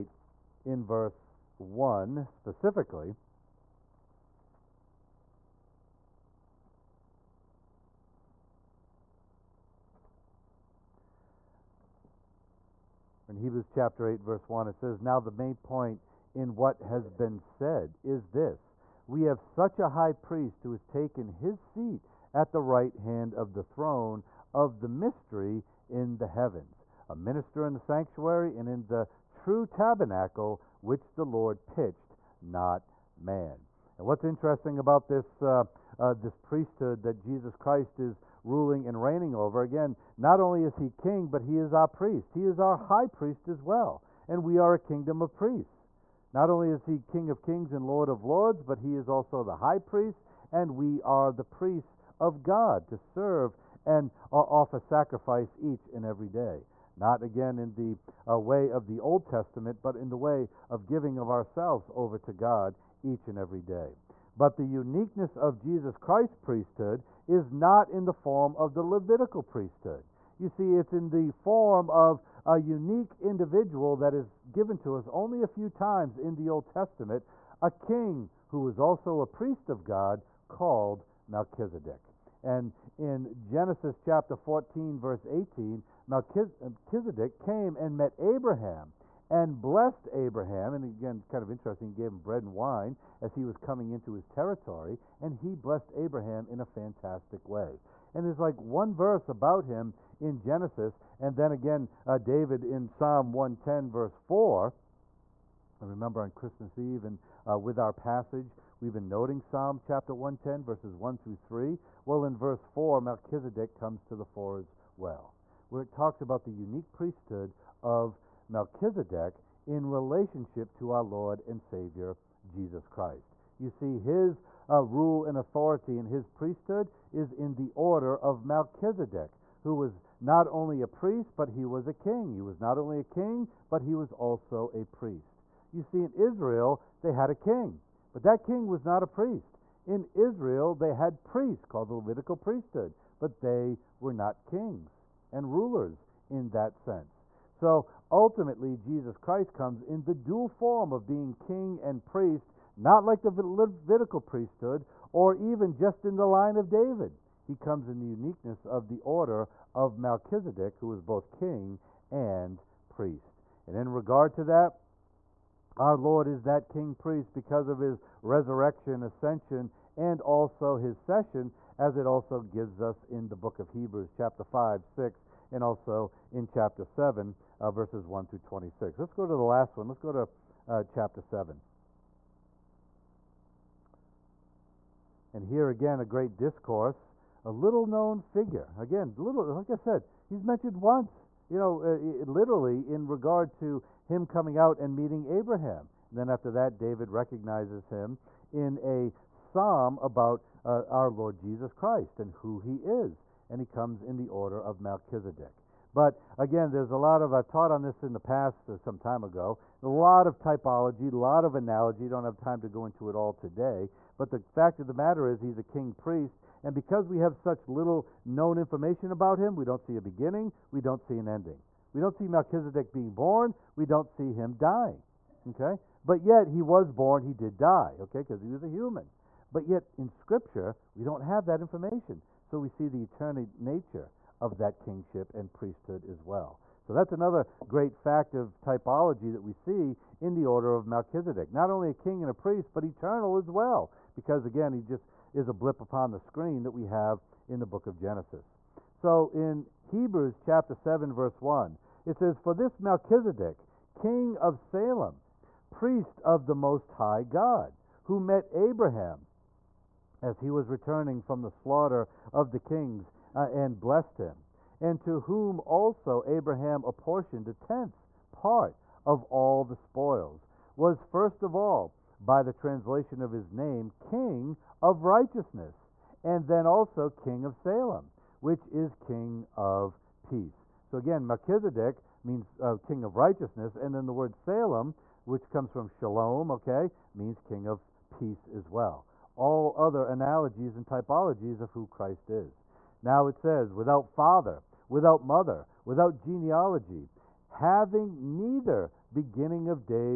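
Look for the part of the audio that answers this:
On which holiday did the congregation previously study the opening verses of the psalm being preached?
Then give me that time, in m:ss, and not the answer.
1:46.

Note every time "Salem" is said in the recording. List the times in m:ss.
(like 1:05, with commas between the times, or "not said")
4:14, 4:37, 4:44.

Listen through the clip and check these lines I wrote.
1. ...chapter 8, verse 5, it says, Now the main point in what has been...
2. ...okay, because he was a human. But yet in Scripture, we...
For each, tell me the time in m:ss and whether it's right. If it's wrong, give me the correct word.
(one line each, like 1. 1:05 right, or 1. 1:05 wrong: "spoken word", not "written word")
1. 0:13 wrong: "1", not "5"
2. 3:48 right.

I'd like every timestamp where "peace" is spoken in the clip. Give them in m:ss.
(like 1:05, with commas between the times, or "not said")
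4:40, 4:48.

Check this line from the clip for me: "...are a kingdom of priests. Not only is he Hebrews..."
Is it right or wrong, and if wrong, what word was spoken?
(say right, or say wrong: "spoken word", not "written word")
wrong: "King", not "Hebrews".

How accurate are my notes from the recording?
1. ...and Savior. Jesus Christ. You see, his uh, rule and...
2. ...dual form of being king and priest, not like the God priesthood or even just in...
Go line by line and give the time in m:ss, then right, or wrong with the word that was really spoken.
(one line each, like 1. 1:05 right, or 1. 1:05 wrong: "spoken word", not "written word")
1. 2:01 right
2. 2:30 wrong: "Levitical", not "God".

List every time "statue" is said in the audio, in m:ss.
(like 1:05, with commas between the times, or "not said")
not said.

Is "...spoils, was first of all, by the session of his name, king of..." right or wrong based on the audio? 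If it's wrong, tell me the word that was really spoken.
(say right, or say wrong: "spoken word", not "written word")
wrong: "translation", not "session".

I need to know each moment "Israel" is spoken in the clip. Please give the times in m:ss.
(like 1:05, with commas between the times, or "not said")
2:16, 2:20.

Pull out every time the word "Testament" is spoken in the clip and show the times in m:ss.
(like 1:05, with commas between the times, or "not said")
0:59, 1:16.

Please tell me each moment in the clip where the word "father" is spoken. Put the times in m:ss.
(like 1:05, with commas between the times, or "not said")
4:54.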